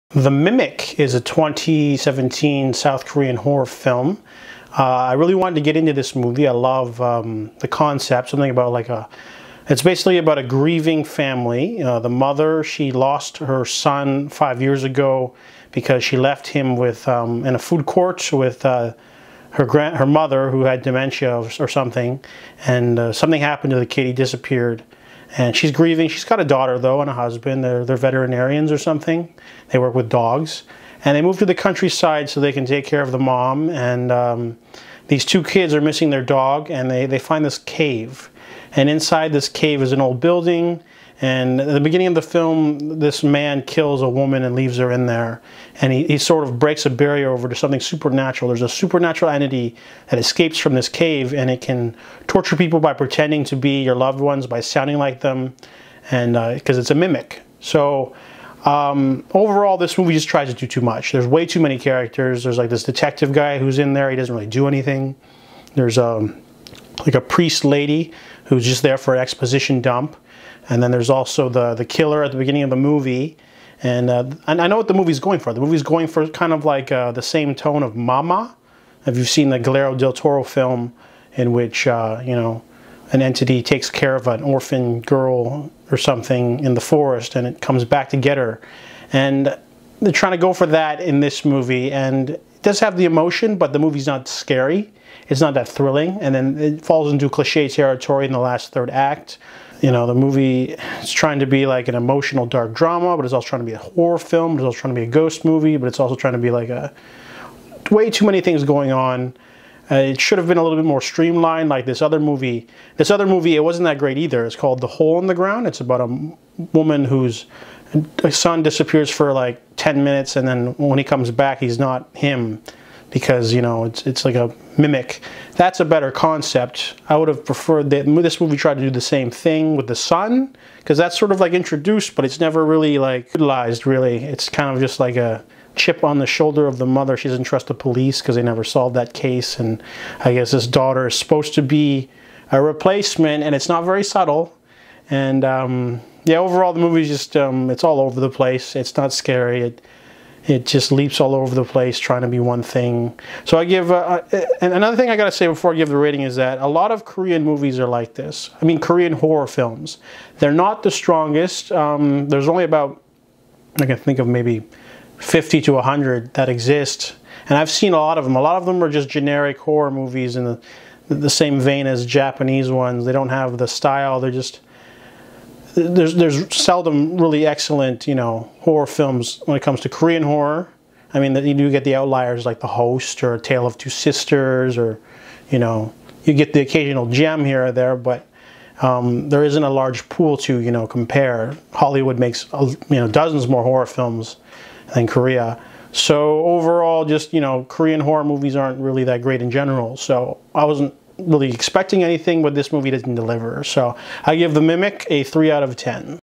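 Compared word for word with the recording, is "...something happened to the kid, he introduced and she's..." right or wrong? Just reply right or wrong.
wrong.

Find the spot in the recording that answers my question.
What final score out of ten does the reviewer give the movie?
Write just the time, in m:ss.
3:25.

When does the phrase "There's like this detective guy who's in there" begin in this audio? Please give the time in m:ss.
1:02.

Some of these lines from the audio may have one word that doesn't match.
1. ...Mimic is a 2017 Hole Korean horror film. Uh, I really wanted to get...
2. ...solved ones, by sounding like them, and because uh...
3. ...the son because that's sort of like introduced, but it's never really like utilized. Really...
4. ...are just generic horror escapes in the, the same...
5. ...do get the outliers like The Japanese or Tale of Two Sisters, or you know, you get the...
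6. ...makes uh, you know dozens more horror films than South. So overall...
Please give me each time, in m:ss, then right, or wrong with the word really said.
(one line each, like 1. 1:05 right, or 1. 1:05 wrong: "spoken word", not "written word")
1. 0:00 wrong: "South", not "Hole"
2. 0:53 wrong: "loved", not "solved"
3. 2:09 right
4. 2:48 wrong: "movies", not "escapes"
5. 3:01 wrong: "Host", not "Japanese"
6. 3:12 wrong: "Korea", not "South".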